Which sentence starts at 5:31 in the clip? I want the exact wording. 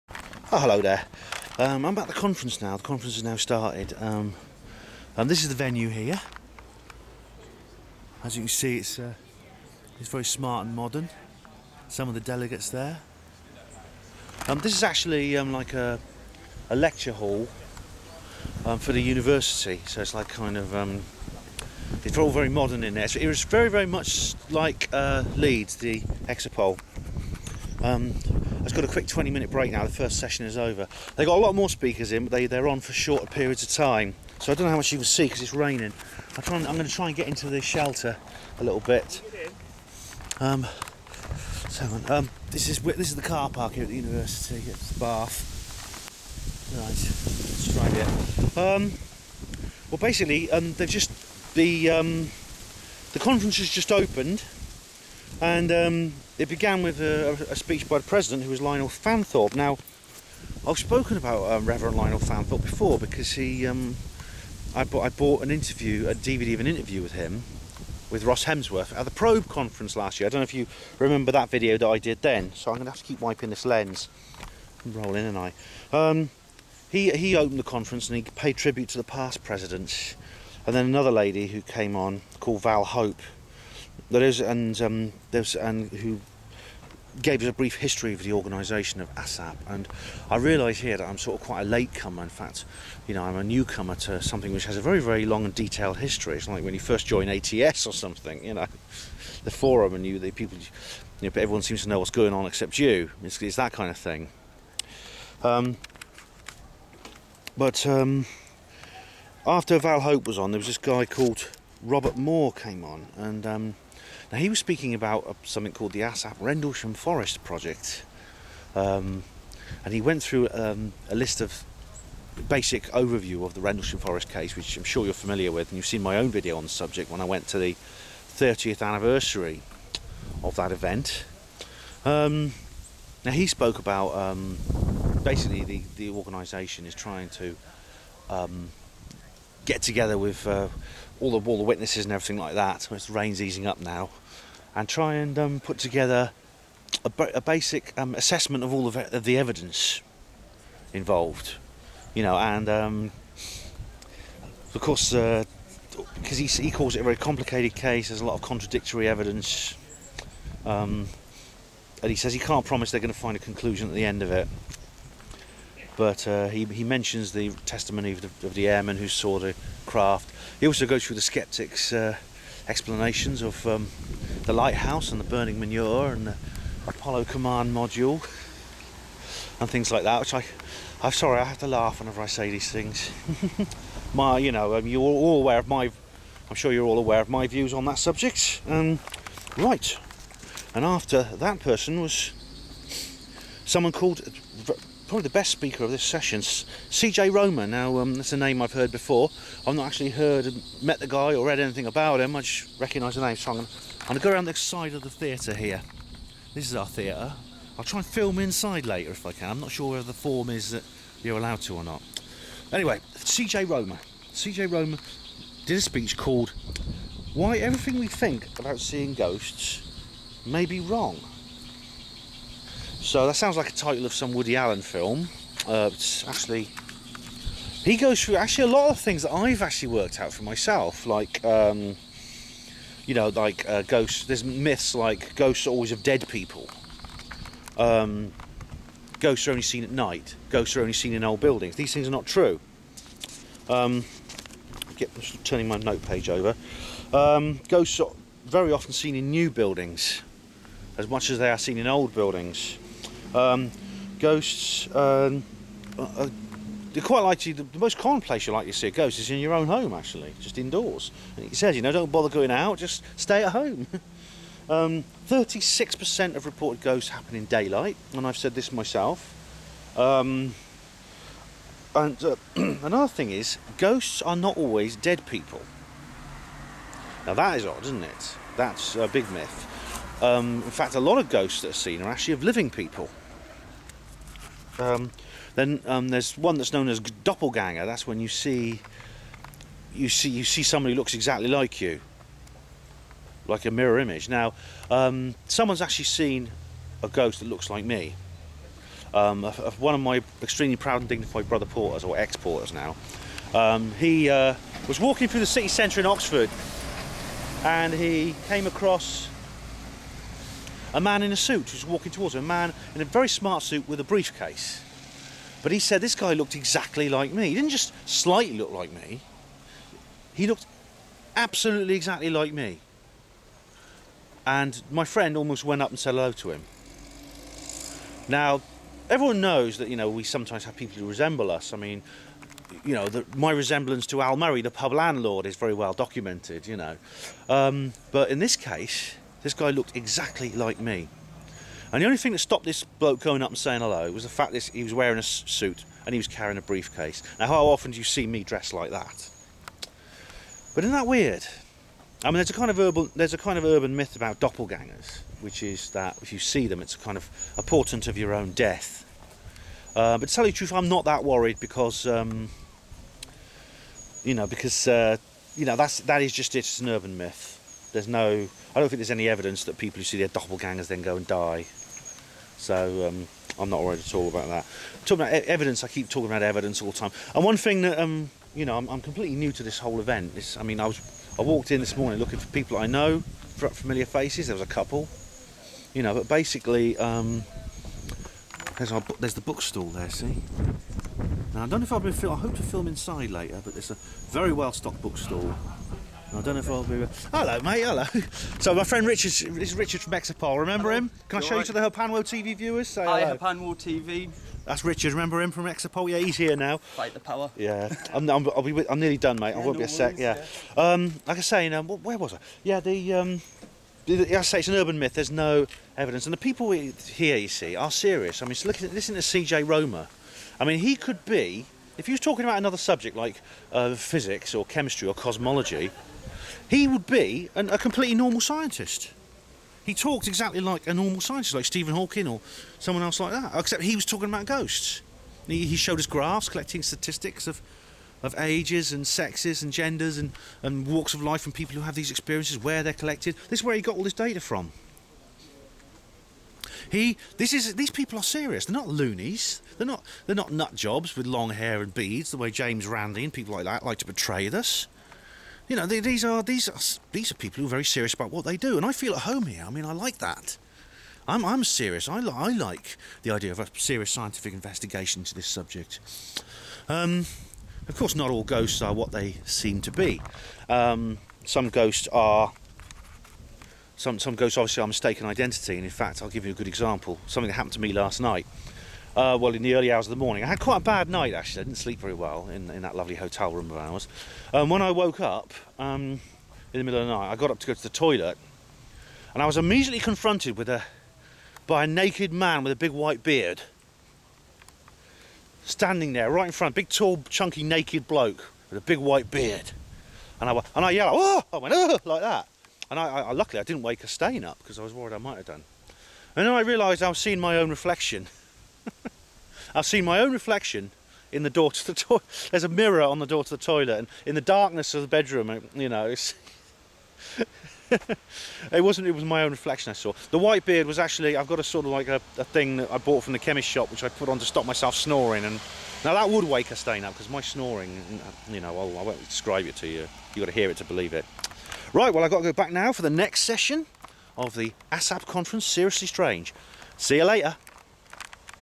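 I mean, you know, the, my resemblance to Al Murray, the pub landlord, is very well documented, you know.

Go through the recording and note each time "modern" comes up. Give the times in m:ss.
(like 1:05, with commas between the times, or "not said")
0:10, 0:22.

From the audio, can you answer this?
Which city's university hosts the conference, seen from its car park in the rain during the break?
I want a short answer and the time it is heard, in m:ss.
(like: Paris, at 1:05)
Bath, at 0:44.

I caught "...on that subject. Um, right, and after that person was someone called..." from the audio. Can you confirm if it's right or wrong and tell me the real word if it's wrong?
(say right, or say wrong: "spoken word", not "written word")
right.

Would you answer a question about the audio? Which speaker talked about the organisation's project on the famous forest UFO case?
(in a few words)
Robert Moore.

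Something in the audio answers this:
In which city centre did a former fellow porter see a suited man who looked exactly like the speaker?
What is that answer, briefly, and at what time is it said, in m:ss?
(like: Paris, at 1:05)
Oxford, at 5:06.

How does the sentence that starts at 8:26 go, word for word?
And then I realised I was seeing my own reflection.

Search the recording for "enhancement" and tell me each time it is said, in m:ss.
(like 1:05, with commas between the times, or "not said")
not said.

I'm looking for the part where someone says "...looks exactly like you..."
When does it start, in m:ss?
4:51.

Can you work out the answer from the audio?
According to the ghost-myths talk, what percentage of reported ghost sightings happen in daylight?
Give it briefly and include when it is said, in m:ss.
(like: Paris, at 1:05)
36%, at 4:24.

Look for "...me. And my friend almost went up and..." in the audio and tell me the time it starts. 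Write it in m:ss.
5:22.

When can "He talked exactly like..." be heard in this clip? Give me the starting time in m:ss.
7:09.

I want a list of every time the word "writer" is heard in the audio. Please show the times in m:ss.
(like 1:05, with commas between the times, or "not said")
not said.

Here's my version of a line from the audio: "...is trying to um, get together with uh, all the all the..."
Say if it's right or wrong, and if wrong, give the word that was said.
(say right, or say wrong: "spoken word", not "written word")
right.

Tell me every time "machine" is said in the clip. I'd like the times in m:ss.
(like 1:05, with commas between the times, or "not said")
not said.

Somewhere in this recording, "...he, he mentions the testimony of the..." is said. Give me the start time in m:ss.
2:46.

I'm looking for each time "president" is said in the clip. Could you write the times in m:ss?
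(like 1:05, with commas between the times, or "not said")
0:58, 1:19.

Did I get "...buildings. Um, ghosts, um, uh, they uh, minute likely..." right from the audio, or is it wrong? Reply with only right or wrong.
wrong.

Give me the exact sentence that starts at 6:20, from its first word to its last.
It's, I mean, I was, I walked in this morning looking for people I know, for familiar faces.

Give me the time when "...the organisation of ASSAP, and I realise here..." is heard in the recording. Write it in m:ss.
1:28.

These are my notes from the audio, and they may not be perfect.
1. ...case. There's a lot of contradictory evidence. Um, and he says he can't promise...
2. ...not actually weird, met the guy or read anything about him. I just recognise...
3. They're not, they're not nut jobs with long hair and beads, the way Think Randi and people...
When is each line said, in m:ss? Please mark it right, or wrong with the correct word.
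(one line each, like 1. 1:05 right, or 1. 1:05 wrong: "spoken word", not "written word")
1. 2:37 right
2. 3:19 wrong: "heard", not "weird"
3. 7:29 wrong: "James", not "Think".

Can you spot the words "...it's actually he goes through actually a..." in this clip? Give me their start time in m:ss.
3:45.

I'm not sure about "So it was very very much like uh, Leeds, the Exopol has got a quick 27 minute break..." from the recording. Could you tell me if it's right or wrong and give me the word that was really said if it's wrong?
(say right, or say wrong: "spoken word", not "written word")
wrong: "20", not "27".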